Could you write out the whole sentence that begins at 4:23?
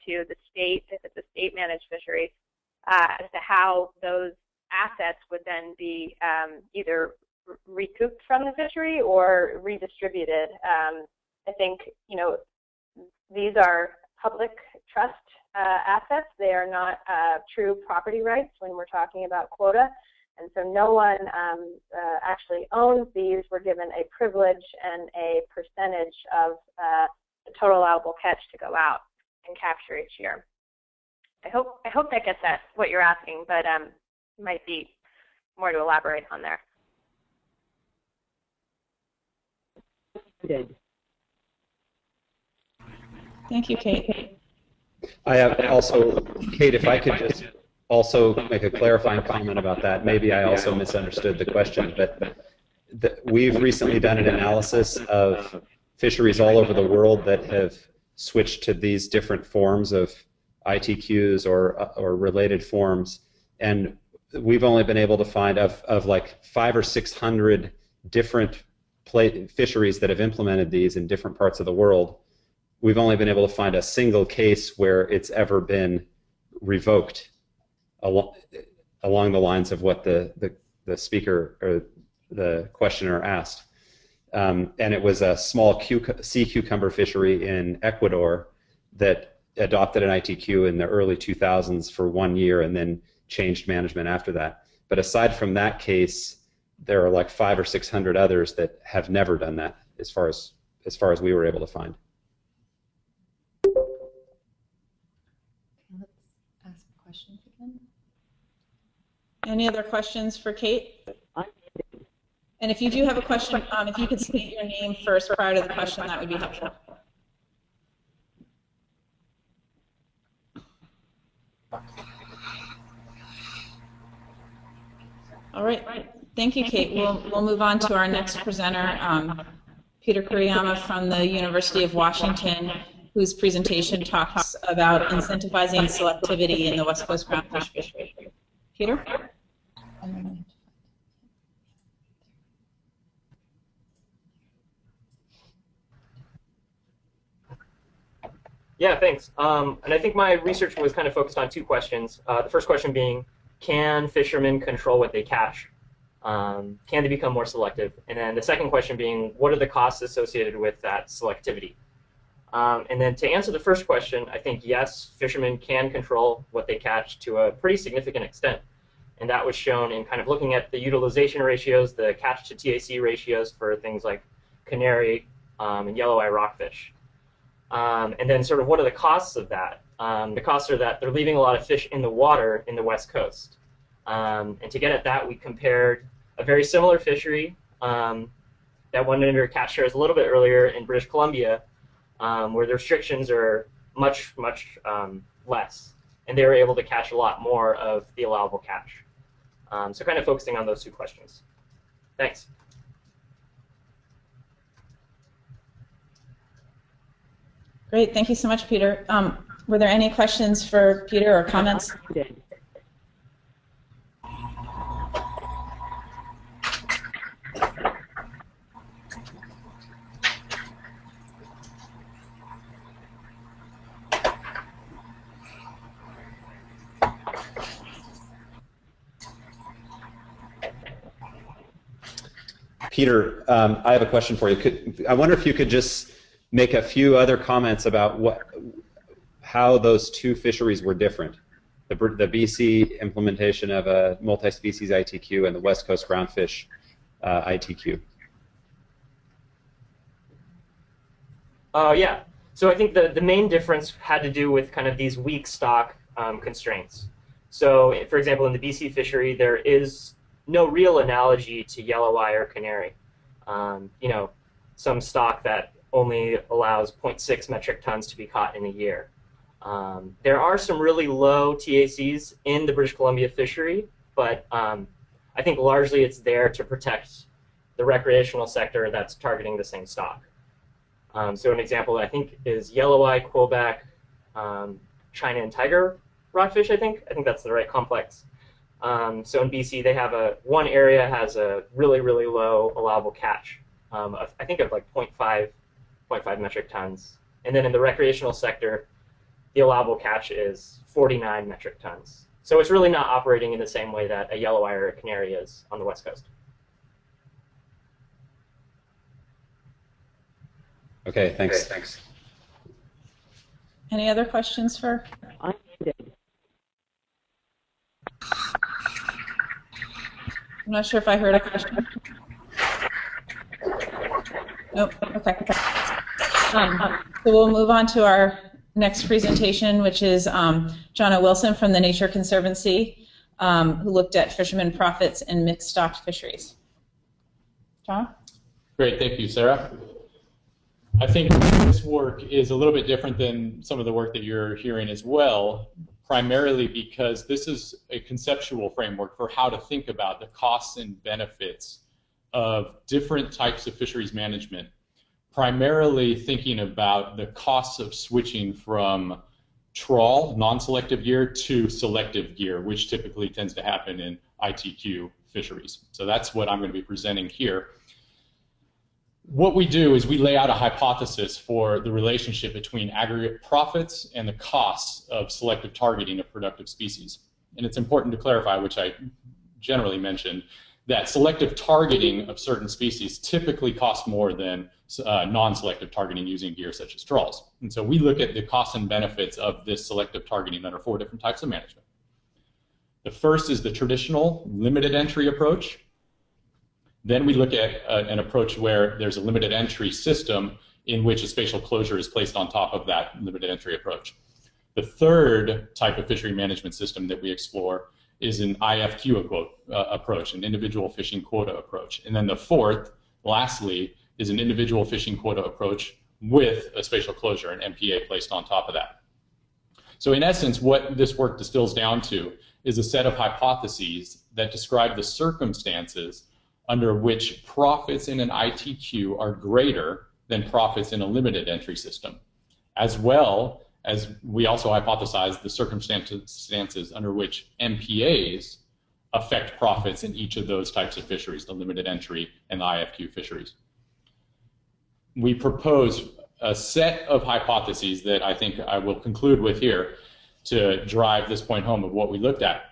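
Um, you know, some stock that only allows 0.6 metric tons to be caught in a year.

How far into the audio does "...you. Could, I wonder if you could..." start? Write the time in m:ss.
3:54.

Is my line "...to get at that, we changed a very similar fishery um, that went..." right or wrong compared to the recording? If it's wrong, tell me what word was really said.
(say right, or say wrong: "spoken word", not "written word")
wrong: "compared", not "changed".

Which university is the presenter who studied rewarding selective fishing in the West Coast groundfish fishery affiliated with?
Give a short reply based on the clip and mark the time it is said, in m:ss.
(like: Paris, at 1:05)
University of Washington, at 2:11.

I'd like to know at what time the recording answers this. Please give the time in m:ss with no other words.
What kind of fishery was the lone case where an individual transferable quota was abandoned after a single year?
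1:26.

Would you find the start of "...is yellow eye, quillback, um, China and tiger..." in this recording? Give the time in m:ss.
4:42.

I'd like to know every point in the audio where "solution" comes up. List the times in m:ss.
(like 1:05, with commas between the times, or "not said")
not said.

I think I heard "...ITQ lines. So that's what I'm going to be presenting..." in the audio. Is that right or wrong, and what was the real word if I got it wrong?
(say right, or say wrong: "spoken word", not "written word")
wrong: "fisheries", not "lines".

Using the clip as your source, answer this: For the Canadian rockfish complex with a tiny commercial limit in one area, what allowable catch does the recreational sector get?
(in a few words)
49 metric tons.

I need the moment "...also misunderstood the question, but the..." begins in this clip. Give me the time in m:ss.
0:50.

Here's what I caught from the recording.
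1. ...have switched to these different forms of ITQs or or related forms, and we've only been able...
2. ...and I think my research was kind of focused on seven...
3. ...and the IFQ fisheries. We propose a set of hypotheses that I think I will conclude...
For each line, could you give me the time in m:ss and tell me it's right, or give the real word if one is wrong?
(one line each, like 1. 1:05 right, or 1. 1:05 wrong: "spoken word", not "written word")
1. 0:57 right
2. 2:29 wrong: "two", not "seven"
3. 7:22 right.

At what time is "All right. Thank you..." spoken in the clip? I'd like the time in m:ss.
2:05.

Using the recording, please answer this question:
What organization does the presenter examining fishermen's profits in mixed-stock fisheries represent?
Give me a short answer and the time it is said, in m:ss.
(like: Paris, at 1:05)
Nature Conservancy, at 5:31.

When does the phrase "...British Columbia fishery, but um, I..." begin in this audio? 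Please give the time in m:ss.
4:32.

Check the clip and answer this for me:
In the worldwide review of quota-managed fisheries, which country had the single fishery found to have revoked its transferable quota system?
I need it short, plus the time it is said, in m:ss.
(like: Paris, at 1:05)
Ecuador, at 1:27.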